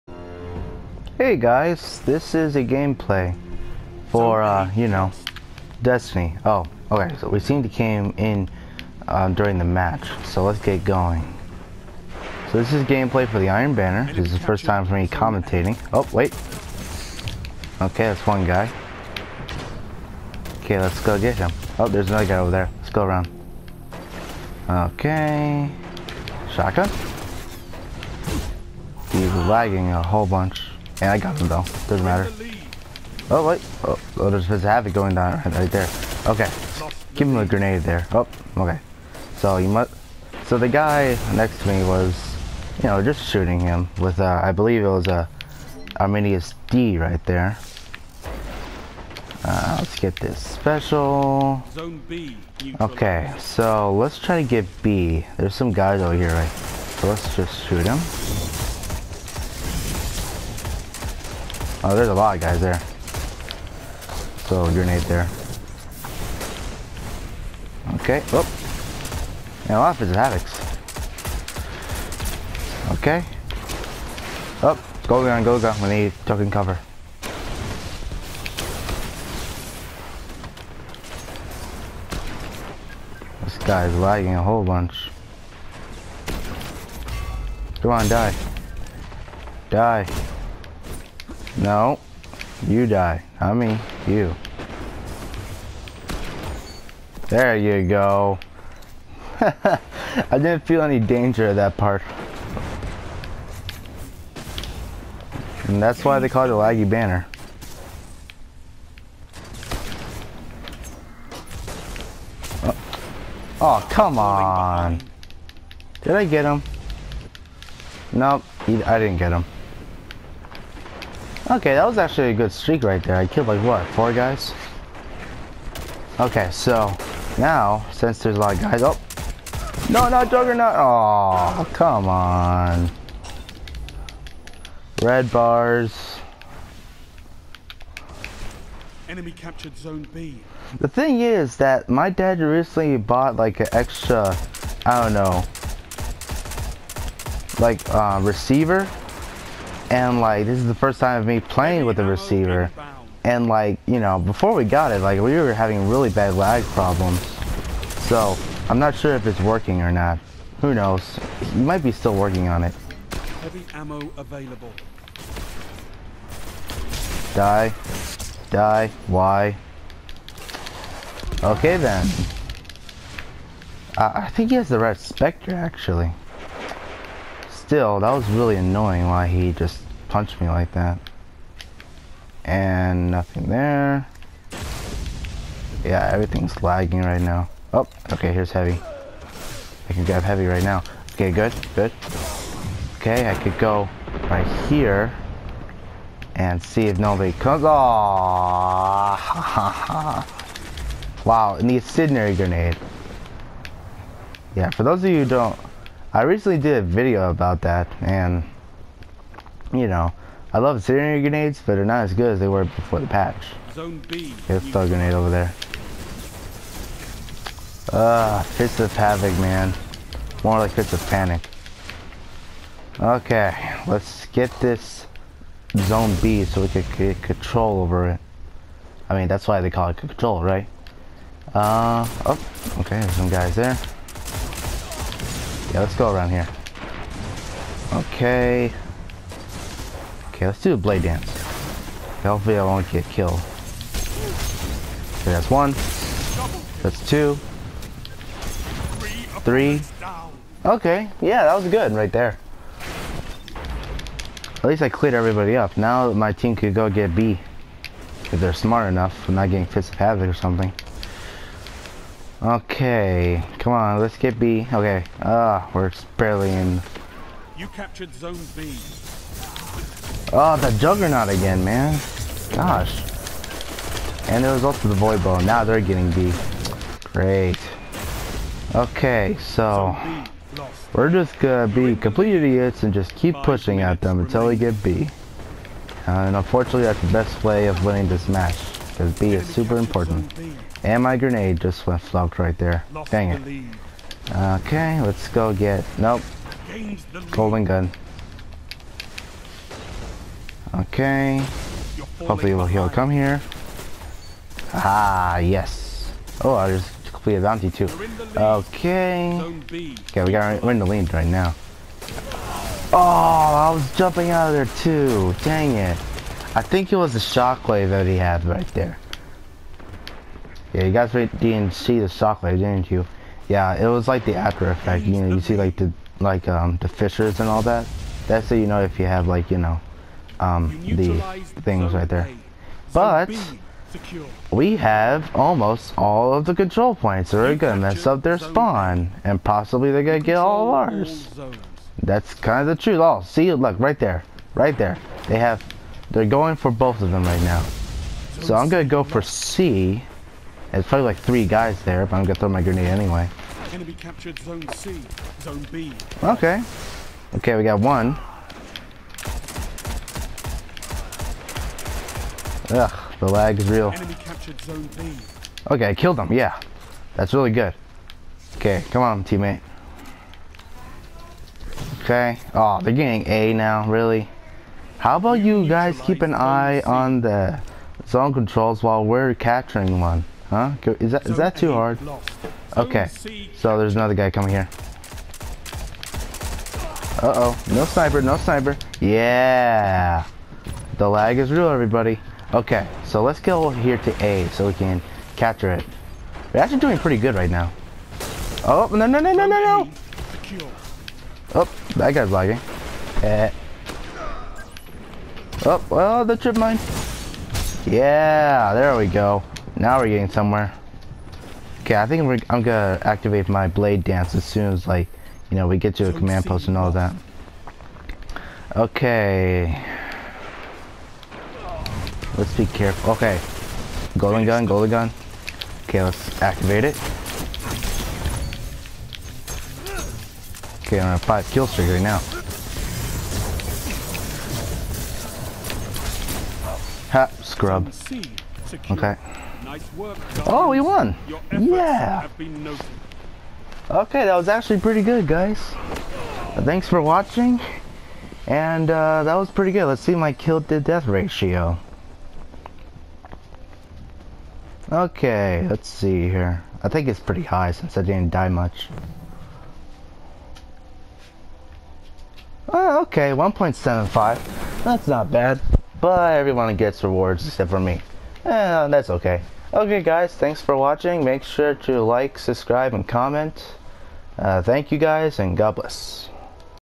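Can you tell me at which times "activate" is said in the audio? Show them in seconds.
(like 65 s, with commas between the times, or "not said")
413 s, 426 s.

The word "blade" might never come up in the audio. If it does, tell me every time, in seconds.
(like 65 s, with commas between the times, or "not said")
240 s, 413 s.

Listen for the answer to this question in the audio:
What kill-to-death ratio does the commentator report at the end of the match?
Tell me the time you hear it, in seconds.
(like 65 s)
463 s.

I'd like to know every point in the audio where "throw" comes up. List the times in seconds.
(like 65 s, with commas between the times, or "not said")
214 s, 352 s.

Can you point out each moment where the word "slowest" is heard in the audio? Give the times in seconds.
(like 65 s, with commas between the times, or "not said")
not said.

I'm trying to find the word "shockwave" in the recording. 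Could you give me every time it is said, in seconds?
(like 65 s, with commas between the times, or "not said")
317 s, 322 s.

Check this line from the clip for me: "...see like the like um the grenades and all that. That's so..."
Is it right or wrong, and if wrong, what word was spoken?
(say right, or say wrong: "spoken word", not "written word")
wrong: "fissures", not "grenades".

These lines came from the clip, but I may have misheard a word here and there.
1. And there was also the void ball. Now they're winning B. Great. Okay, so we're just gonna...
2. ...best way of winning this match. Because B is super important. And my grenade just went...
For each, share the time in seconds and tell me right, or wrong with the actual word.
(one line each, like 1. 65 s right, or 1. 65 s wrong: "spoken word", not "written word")
1. 274 s wrong: "getting", not "winning"
2. 287 s right.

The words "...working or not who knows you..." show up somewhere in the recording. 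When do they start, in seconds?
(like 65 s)
159 s.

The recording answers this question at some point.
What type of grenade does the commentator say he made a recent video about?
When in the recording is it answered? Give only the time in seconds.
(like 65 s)
210 s.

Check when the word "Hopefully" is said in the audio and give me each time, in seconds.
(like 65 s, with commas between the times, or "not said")
242 s, 302 s.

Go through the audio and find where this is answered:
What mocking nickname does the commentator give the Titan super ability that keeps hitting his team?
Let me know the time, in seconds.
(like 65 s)
220 s.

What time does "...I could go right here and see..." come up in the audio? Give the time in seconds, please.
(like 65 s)
193 s.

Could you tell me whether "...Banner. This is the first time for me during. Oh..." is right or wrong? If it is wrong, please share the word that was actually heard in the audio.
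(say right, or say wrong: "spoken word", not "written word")
wrong: "commentating", not "during".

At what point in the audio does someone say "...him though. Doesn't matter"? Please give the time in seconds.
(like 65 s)
31 s.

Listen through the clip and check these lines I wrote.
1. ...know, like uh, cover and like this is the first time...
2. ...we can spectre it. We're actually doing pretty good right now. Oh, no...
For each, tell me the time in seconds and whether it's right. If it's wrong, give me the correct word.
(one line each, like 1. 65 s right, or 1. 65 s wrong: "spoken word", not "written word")
1. 145 s wrong: "receiver", not "cover"
2. 394 s wrong: "capture", not "spectre".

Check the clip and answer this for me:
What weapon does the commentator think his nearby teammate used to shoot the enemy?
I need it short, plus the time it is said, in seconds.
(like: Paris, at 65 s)
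Arminius D, at 45 s.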